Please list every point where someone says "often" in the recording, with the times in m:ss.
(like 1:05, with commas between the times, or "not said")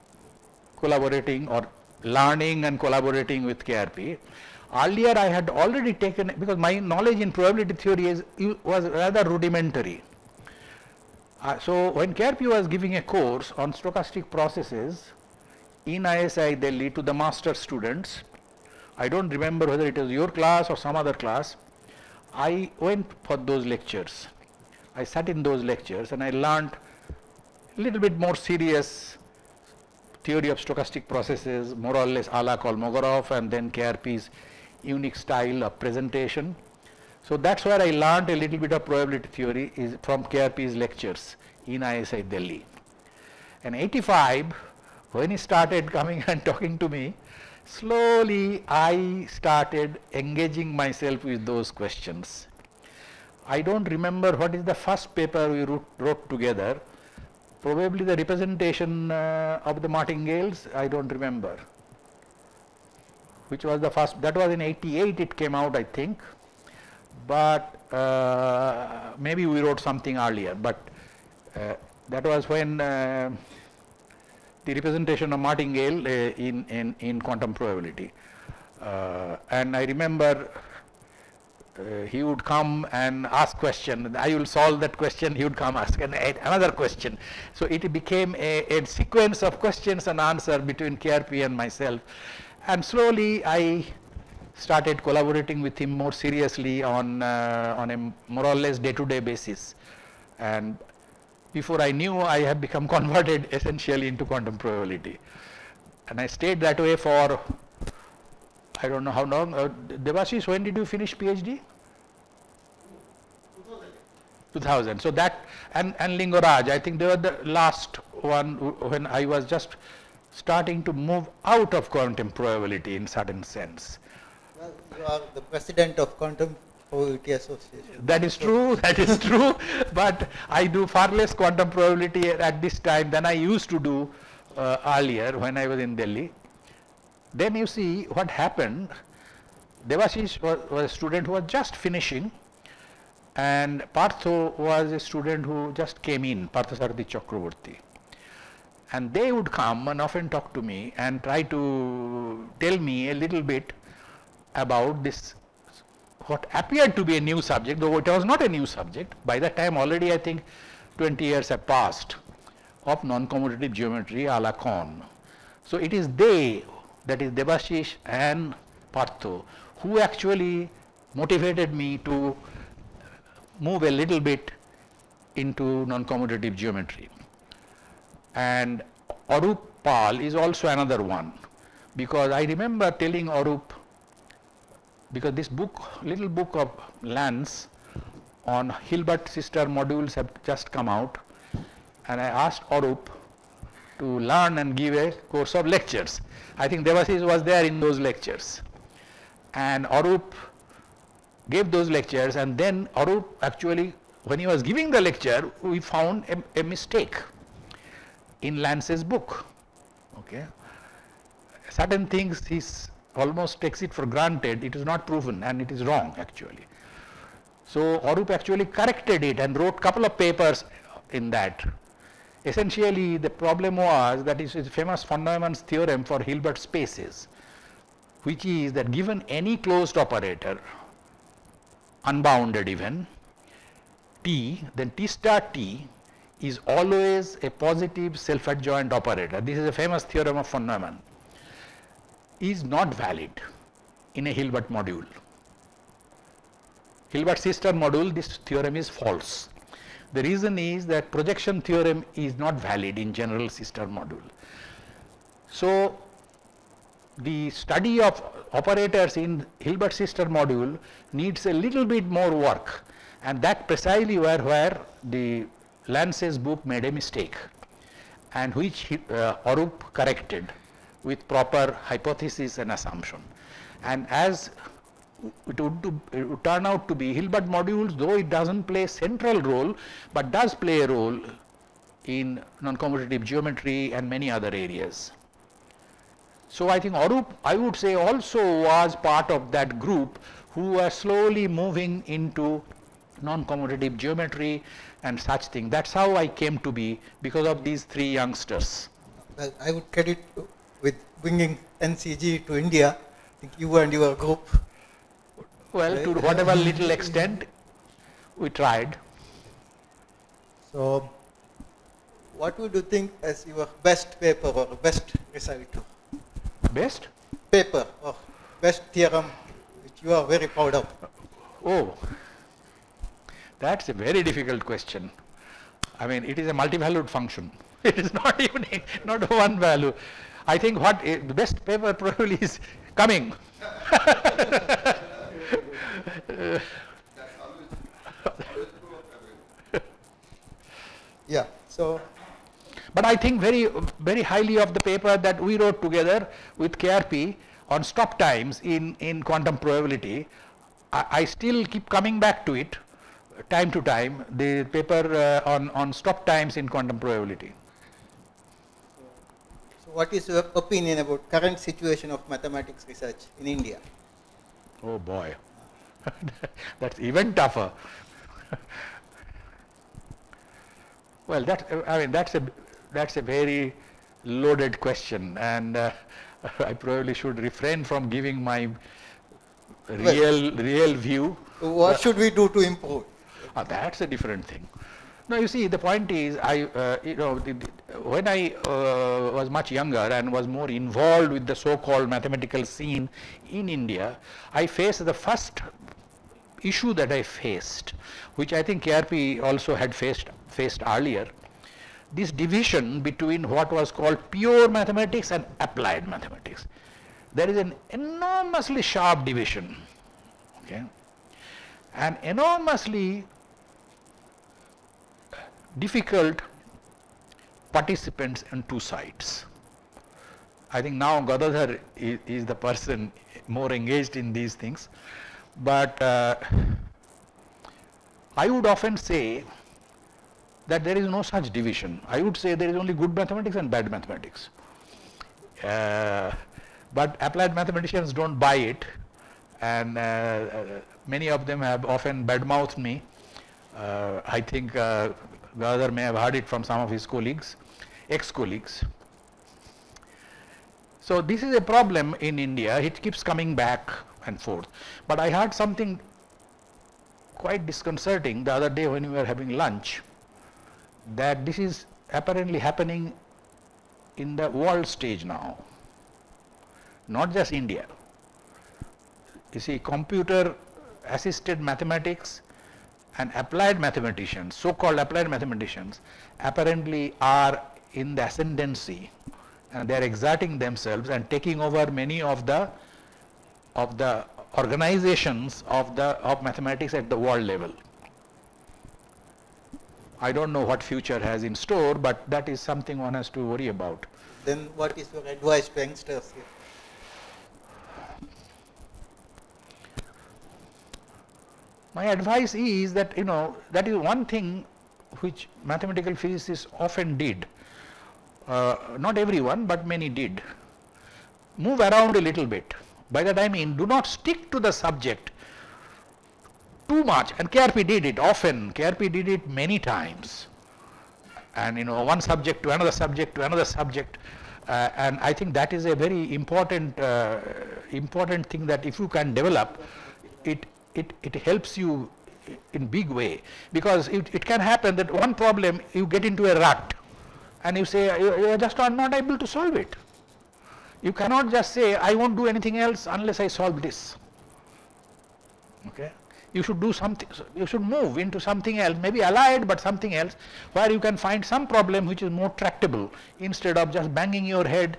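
2:29, 7:08, 7:21, 8:26, 8:38.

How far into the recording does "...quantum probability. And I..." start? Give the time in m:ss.
1:44.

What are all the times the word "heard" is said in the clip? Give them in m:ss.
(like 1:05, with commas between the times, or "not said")
7:26, 7:35.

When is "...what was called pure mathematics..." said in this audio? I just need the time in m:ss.
6:43.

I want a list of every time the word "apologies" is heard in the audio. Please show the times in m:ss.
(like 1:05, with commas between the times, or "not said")
not said.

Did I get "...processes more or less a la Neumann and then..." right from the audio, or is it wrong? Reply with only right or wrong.
wrong.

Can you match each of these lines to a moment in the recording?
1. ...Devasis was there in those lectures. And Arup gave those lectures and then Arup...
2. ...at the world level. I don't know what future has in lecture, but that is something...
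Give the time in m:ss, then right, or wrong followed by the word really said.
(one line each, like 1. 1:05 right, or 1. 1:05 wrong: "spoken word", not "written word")
1. 3:16 right
2. 8:06 wrong: "store", not "lecture".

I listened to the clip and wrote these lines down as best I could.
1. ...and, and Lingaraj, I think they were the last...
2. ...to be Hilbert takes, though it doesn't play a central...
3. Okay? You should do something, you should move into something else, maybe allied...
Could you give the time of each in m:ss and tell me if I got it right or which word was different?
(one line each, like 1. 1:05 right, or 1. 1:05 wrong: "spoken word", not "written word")
1. 1:55 right
2. 4:36 wrong: "modules", not "takes"
3. 9:05 right.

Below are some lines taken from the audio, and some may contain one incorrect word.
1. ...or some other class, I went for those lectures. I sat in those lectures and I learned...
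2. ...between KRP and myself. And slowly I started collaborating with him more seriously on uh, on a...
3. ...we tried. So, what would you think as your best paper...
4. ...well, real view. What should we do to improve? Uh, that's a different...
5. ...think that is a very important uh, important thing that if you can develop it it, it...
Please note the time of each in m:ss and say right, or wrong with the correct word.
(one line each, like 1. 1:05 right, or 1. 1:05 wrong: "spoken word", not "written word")
1. 0:20 right
2. 1:30 right
3. 5:08 right
4. 6:20 right
5. 8:45 right.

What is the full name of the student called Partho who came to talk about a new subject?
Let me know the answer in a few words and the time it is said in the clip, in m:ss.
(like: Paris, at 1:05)
Parthasarathi Chakraborty, at 2:26.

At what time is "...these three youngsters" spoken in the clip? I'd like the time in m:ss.
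4:57.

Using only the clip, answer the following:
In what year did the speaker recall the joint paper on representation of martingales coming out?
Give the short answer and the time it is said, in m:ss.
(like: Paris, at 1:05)
1988, at 1:04.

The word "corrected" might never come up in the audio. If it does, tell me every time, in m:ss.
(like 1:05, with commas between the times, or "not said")
3:38, 4:29.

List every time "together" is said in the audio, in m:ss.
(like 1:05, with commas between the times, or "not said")
0:56, 5:45.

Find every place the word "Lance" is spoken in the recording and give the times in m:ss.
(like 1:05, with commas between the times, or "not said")
3:07, 3:28, 4:25.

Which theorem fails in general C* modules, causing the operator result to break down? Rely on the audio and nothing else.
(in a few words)
projection theorem.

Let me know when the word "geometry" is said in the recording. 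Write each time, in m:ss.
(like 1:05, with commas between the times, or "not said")
2:43, 2:56, 4:43, 4:53.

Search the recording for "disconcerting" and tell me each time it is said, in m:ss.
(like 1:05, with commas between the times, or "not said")
7:37.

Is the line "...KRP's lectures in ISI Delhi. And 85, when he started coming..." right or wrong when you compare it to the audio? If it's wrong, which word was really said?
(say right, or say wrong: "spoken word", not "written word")
right.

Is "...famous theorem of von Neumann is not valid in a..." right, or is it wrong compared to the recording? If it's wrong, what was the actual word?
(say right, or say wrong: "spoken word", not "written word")
right.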